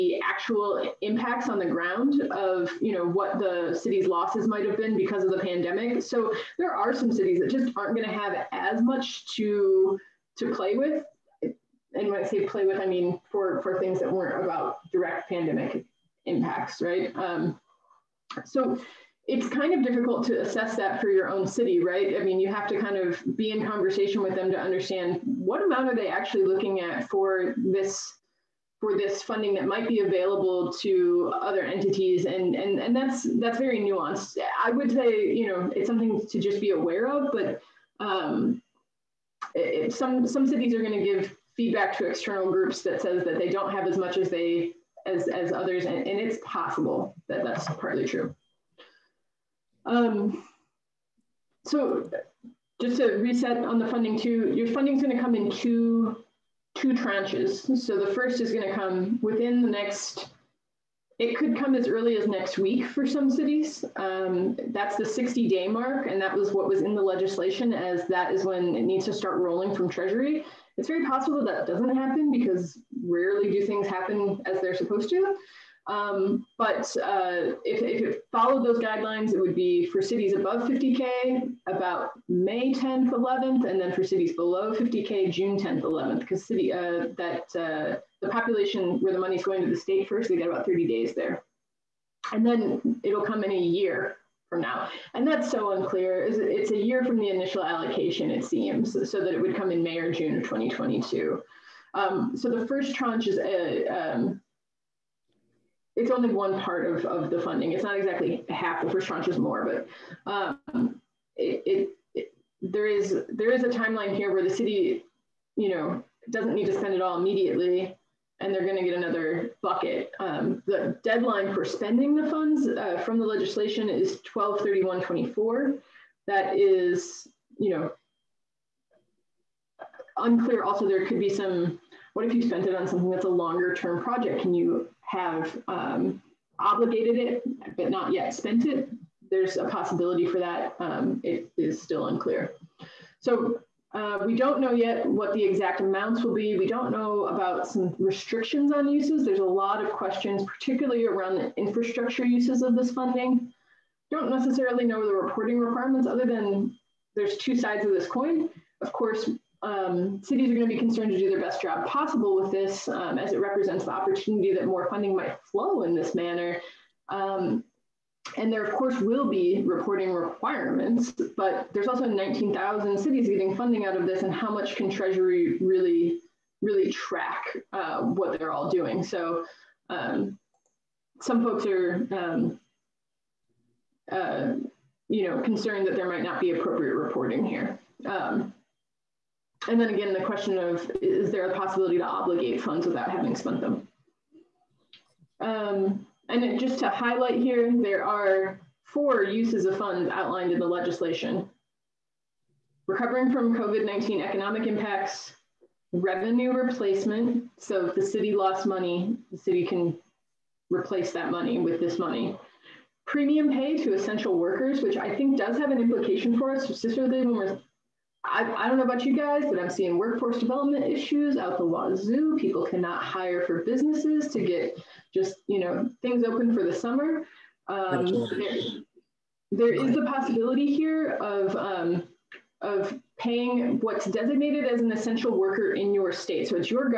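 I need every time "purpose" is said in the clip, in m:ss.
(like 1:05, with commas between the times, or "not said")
not said.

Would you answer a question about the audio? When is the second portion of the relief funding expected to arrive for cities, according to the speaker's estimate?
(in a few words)
May or June of 2022.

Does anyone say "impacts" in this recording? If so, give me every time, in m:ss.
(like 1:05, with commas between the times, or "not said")
0:00, 0:16, 3:24.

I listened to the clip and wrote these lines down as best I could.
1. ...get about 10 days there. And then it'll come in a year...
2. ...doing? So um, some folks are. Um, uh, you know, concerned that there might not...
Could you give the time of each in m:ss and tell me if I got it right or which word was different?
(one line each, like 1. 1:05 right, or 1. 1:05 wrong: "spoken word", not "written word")
1. 1:30 wrong: "30", not "10"
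2. 2:58 right.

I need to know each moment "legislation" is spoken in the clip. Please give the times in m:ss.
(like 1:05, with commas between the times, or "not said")
1:07, 2:03, 3:20.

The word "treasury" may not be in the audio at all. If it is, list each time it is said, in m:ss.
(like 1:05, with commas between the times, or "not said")
1:09, 2:54.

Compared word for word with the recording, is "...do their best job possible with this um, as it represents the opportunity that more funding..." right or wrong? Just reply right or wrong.
right.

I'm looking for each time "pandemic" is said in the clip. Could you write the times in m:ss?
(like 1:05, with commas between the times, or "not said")
0:05, 0:15.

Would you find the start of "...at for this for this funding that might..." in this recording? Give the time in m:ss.
0:26.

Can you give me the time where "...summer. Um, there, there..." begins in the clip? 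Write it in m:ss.
3:46.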